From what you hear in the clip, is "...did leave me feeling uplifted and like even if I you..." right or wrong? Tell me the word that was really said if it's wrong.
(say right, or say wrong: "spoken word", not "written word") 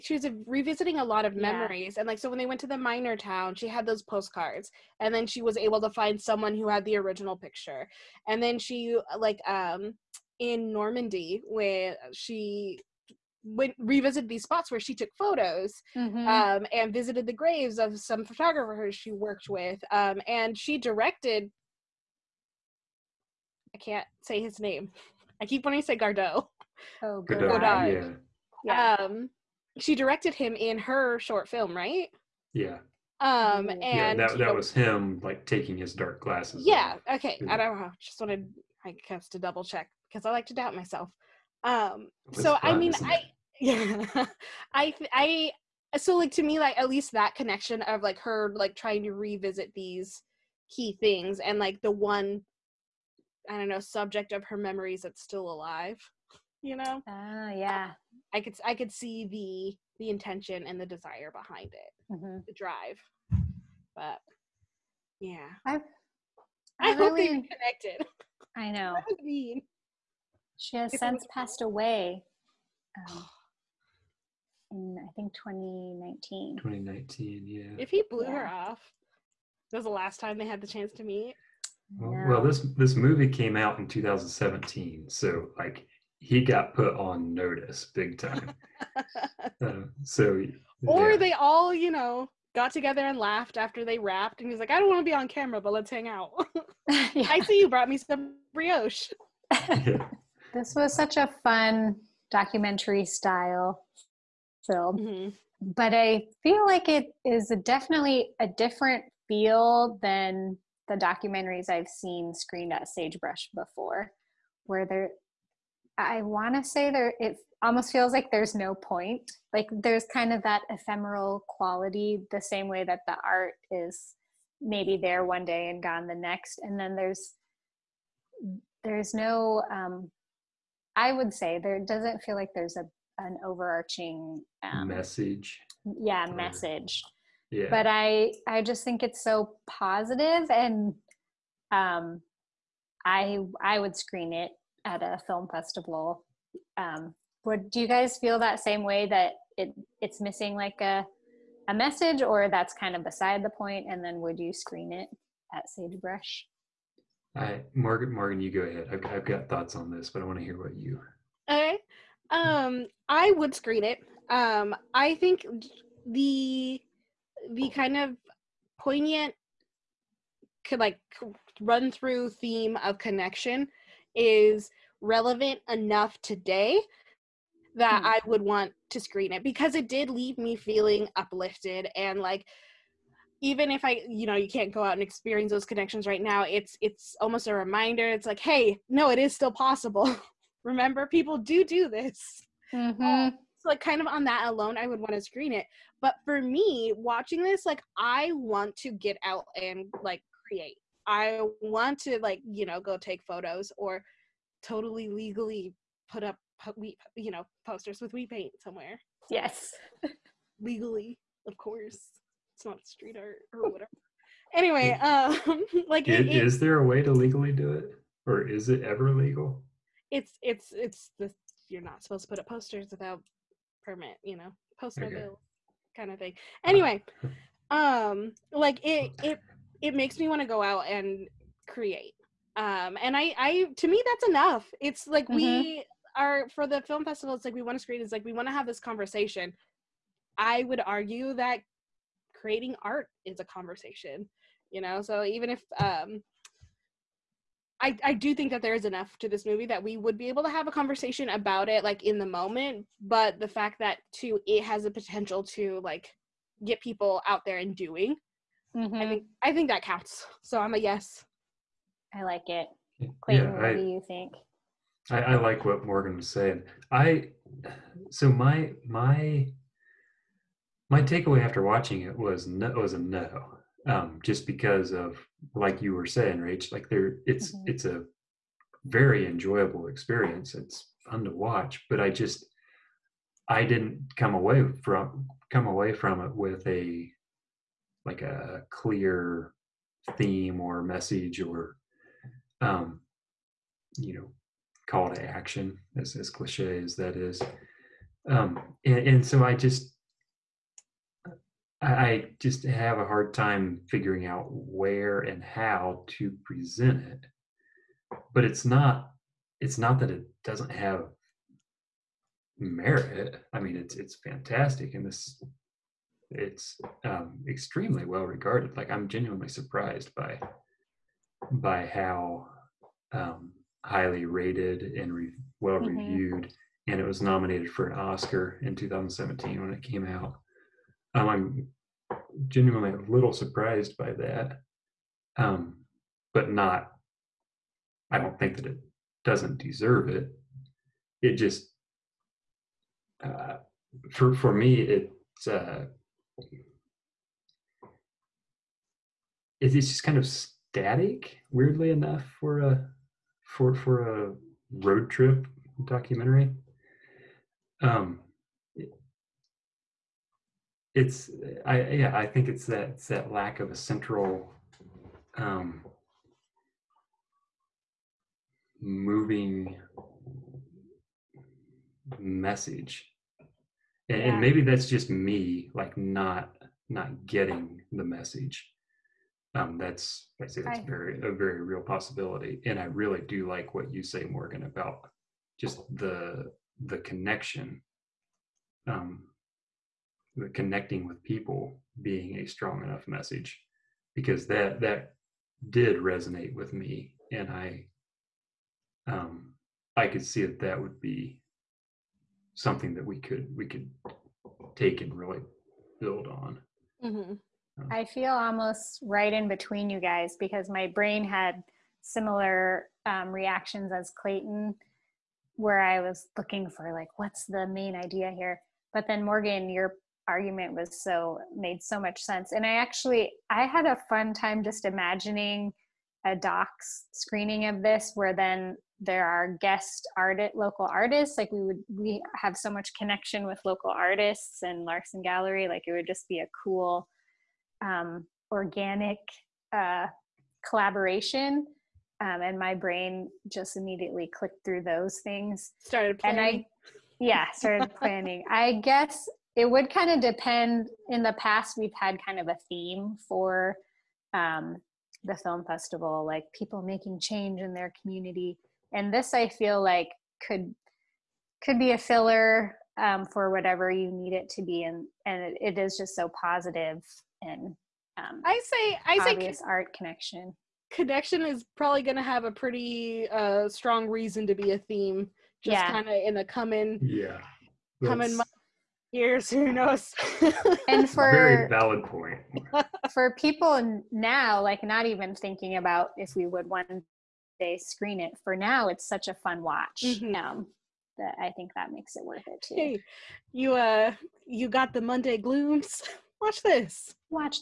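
right.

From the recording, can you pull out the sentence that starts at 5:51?
Weirdly enough, for a for for a road trip documentary.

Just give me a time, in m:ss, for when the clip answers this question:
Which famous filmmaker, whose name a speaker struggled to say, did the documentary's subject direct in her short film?
0:27.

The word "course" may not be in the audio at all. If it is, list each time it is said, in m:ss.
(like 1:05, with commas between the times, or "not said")
3:31.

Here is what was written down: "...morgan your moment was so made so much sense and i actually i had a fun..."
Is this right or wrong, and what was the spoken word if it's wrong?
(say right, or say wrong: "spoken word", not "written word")
wrong: "argument", not "moment".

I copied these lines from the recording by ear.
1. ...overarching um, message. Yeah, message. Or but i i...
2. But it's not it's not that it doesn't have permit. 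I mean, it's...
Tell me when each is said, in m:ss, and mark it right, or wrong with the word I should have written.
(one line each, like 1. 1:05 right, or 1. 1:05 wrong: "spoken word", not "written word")
1. 2:13 right
2. 5:08 wrong: "merit", not "permit".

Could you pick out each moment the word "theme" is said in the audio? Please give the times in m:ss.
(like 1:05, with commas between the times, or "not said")
2:52, 4:50, 7:32, 7:54.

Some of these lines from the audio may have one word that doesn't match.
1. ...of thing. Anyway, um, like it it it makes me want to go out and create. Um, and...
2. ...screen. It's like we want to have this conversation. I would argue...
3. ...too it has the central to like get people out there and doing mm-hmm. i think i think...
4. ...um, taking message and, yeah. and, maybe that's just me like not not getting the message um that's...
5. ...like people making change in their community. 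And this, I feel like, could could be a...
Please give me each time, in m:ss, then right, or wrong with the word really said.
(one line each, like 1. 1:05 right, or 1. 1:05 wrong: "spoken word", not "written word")
1. 3:46 right
2. 3:57 right
3. 4:14 wrong: "potential", not "central"
4. 6:05 wrong: "moving", not "taking"
5. 7:36 right.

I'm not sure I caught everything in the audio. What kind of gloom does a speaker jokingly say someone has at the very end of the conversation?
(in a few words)
Monday glooms.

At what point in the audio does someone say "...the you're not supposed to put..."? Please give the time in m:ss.
3:41.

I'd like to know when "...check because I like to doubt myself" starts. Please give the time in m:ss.
0:39.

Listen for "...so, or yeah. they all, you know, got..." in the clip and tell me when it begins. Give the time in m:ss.
1:30.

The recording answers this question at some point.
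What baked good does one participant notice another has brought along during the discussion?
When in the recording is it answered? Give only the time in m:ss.
1:38.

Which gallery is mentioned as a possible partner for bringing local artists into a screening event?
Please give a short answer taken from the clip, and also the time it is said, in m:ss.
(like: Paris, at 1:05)
Larson Gallery, at 7:14.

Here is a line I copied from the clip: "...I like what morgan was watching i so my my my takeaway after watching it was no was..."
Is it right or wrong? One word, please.
wrong.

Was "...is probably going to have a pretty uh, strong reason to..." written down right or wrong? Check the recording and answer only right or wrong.
right.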